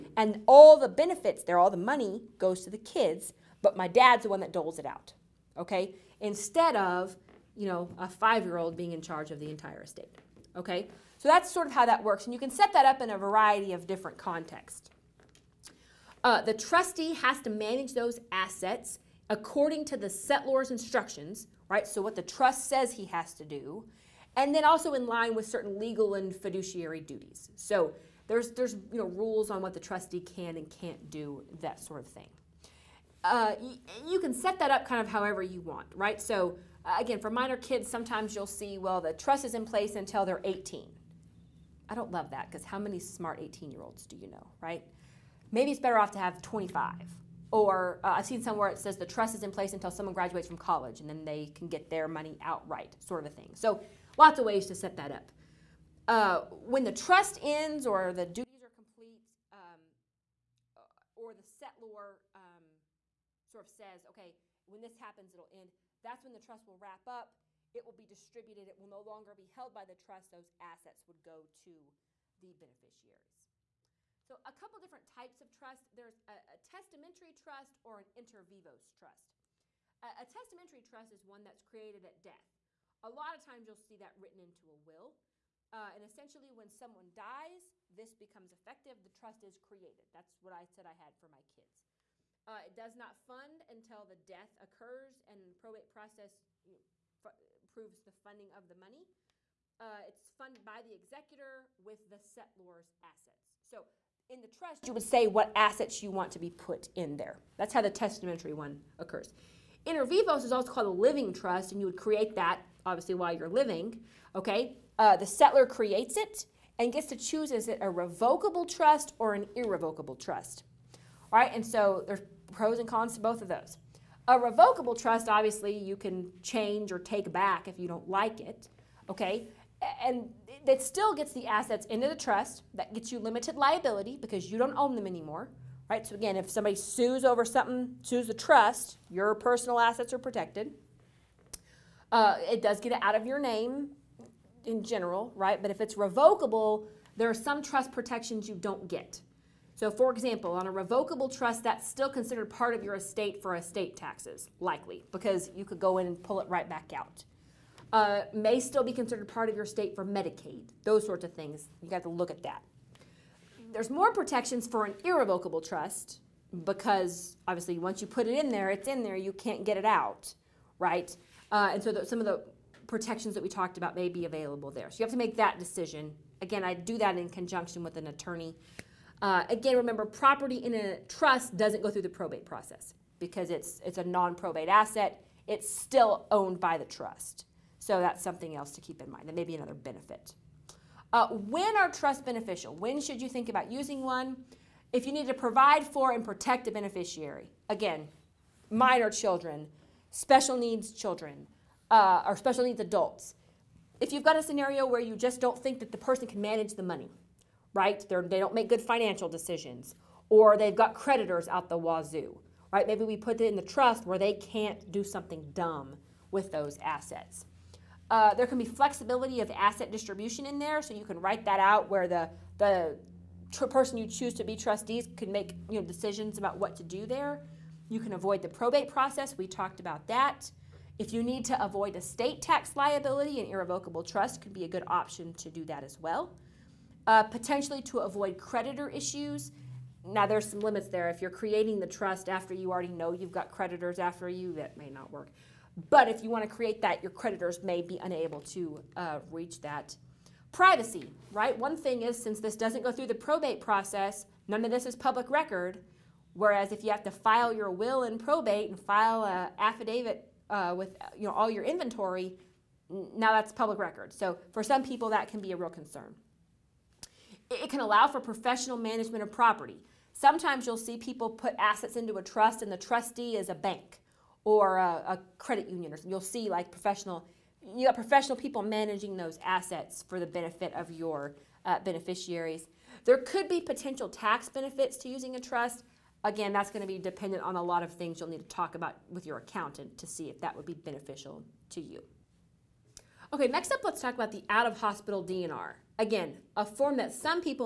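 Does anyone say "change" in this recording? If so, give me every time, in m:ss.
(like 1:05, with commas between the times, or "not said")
2:06.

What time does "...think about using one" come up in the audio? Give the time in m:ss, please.
3:13.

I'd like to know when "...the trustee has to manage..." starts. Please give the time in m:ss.
0:16.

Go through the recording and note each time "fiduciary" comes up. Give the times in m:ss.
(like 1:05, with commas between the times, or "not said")
0:26.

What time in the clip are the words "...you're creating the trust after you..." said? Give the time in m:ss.
4:01.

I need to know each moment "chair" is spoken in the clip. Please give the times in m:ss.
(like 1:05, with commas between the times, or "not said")
not said.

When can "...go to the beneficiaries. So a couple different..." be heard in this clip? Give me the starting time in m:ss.
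1:11.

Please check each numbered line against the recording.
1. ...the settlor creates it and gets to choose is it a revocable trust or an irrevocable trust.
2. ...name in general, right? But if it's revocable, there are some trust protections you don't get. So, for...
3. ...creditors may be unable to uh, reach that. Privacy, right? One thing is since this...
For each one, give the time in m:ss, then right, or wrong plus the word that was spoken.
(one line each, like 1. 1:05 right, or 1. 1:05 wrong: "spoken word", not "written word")
1. 1:55 right
2. 2:23 right
3. 4:07 right.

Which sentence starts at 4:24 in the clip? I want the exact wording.
So for some people, that can be a real concern.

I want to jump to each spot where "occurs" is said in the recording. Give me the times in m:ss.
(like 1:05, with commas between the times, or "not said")
1:34, 1:48.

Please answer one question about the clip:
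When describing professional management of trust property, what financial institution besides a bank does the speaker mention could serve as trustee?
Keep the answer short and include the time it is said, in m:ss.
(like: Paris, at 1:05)
a credit union, at 4:35.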